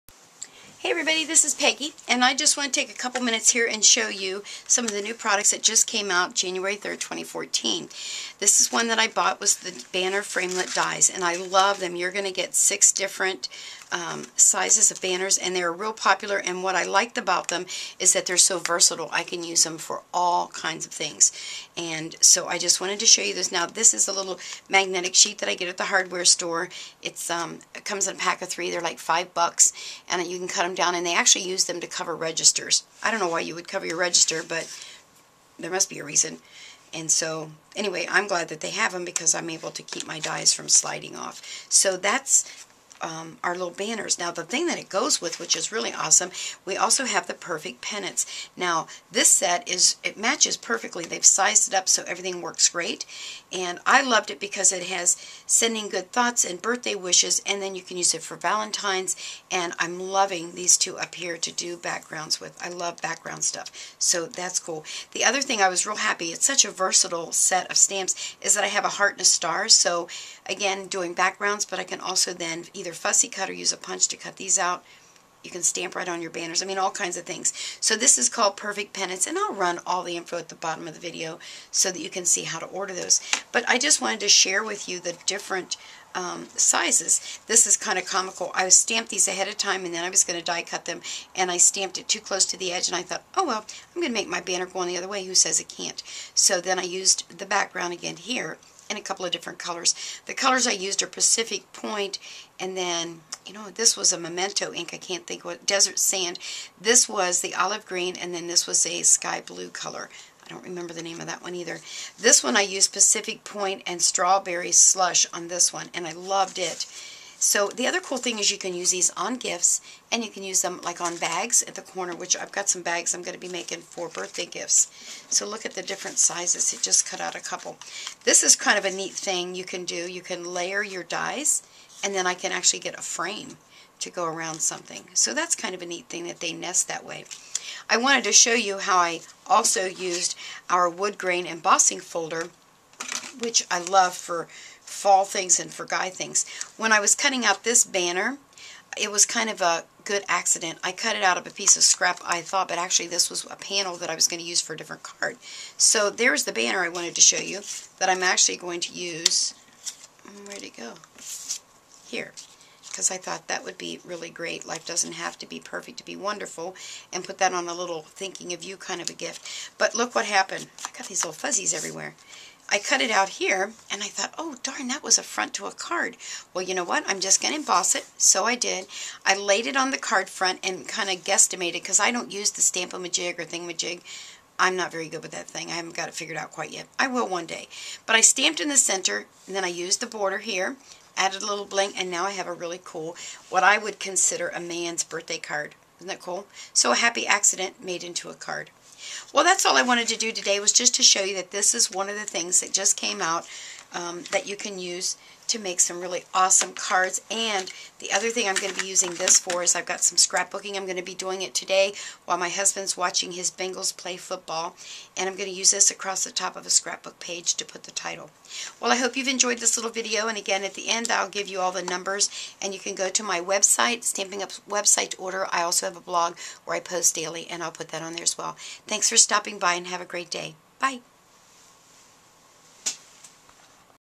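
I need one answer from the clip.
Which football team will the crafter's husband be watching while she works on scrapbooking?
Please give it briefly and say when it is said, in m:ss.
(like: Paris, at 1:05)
Bengals, at 3:33.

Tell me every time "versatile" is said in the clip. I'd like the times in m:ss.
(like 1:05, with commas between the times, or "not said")
0:18, 1:06.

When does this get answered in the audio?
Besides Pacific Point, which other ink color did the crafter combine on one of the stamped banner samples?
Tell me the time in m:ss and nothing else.
1:54.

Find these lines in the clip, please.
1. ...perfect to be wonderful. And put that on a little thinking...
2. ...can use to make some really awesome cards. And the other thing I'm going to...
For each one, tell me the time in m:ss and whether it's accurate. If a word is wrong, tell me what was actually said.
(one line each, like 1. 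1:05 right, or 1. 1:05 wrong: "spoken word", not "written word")
1. 2:45 right
2. 3:24 right.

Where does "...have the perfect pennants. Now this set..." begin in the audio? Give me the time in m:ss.
0:47.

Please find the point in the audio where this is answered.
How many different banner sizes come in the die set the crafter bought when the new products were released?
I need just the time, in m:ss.
0:12.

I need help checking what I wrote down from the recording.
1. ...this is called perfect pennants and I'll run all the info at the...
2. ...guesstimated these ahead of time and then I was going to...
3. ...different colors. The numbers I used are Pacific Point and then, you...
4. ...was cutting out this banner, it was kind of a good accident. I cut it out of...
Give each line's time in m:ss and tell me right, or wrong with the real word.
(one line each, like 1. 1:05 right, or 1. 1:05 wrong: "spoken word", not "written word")
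1. 1:17 right
2. 1:28 wrong: "stamped", not "guesstimated"
3. 1:39 wrong: "colors", not "numbers"
4. 2:26 right.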